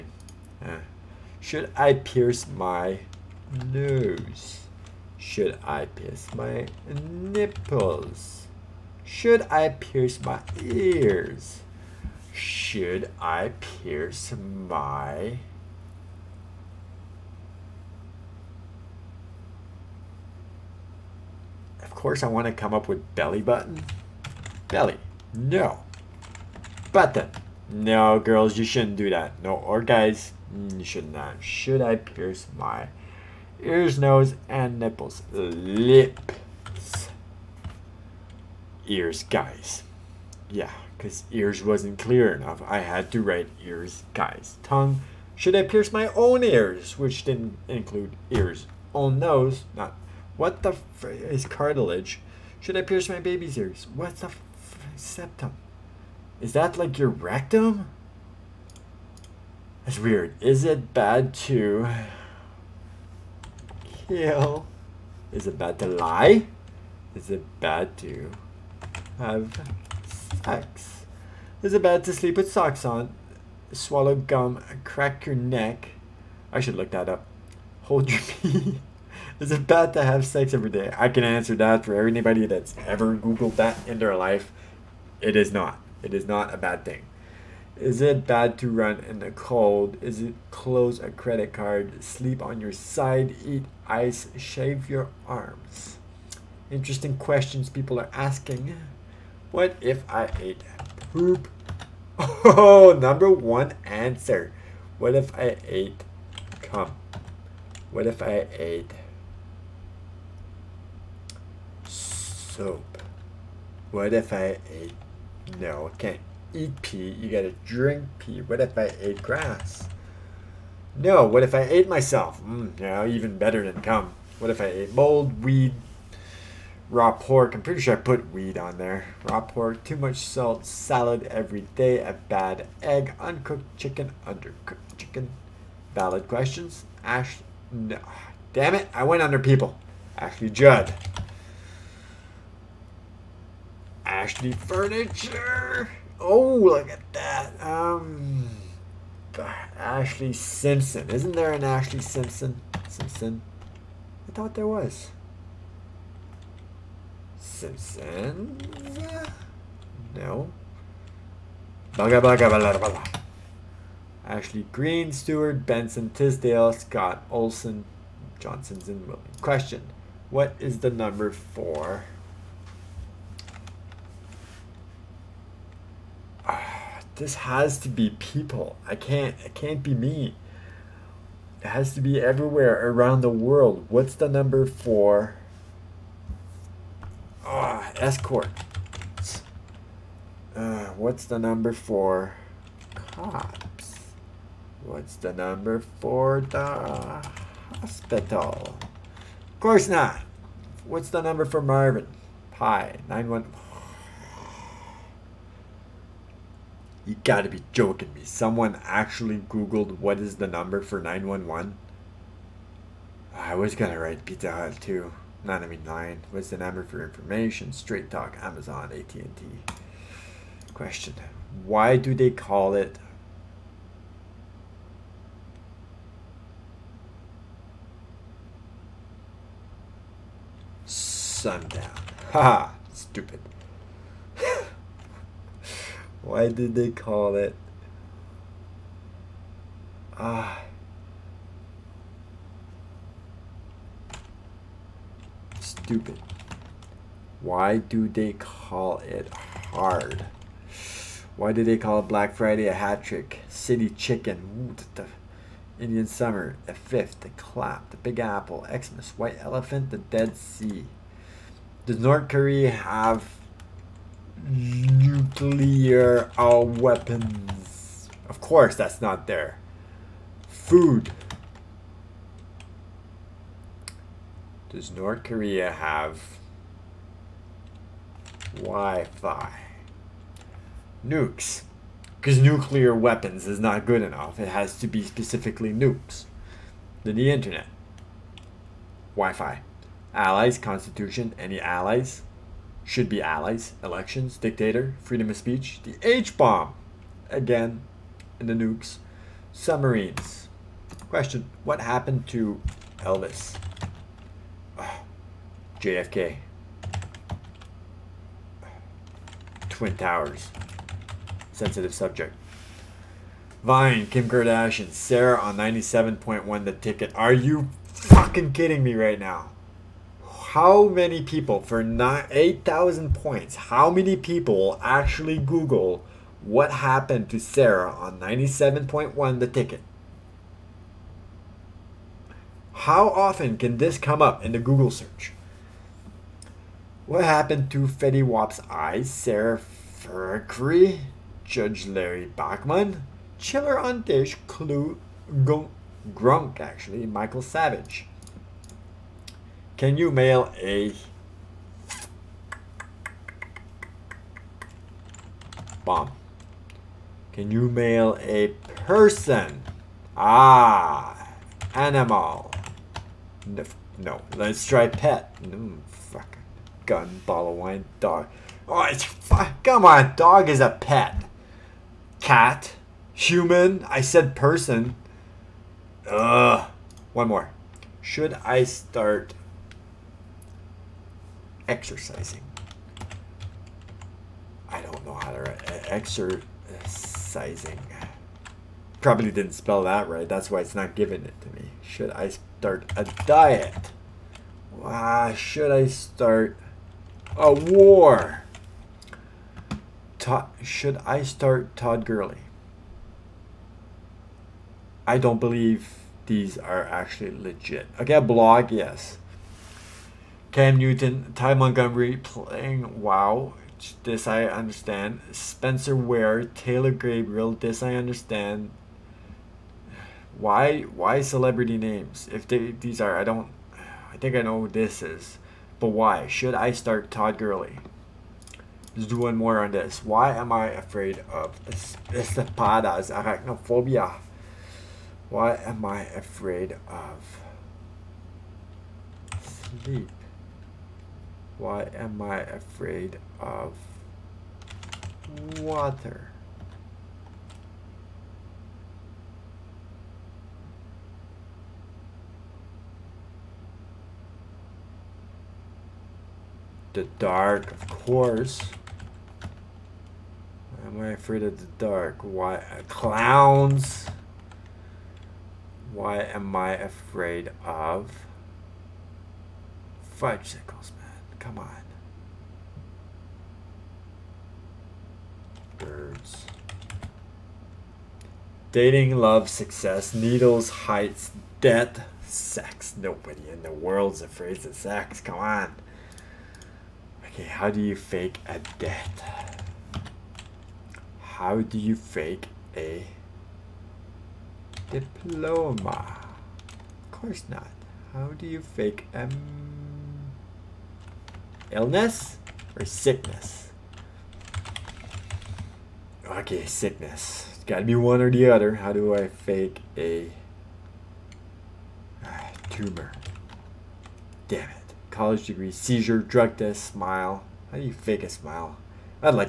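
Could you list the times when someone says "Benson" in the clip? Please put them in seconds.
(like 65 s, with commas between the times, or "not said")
165 s.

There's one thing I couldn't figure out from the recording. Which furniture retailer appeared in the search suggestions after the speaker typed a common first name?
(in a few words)
Ashley Furniture.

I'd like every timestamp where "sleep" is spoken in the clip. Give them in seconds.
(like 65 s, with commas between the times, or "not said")
72 s, 92 s, 439 s.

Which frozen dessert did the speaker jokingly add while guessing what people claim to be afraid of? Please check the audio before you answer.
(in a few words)
Fudgesicles.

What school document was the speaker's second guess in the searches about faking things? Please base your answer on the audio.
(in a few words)
Diploma.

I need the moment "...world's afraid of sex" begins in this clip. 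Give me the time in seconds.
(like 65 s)
483 s.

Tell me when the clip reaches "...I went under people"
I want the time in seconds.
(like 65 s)
138 s.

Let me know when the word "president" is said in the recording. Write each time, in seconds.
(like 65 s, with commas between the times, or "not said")
not said.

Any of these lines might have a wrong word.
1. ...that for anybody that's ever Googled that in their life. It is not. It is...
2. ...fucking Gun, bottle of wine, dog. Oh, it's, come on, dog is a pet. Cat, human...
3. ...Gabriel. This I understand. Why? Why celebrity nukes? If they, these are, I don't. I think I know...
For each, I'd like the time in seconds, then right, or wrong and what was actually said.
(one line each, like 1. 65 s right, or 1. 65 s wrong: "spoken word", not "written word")
1. 81 s right
2. 365 s right
3. 416 s wrong: "names", not "nukes".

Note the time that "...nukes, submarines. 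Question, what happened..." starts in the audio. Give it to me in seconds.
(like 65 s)
298 s.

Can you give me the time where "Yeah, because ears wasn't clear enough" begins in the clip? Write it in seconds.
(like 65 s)
40 s.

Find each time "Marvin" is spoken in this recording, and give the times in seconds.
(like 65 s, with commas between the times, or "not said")
201 s.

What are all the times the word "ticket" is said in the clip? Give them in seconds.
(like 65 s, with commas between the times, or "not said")
316 s, 329 s.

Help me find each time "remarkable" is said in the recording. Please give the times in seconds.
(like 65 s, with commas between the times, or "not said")
not said.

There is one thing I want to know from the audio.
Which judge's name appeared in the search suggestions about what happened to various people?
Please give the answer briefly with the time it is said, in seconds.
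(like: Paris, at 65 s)
Judge Larry Bachman, at 341 s.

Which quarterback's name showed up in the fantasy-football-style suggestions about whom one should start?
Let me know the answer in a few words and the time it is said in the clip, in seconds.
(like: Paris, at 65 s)
Cam Newton, at 410 s.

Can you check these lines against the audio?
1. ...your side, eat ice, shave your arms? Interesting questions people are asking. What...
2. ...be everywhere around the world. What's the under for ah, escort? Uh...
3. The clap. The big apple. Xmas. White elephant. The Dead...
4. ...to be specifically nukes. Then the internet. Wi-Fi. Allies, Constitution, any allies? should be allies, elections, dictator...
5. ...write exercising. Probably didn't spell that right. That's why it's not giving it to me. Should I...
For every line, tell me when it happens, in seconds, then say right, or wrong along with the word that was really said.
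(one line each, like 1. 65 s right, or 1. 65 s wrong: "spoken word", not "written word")
1. 92 s right
2. 182 s wrong: "number", not "under"
3. 257 s right
4. 284 s right
5. 385 s right.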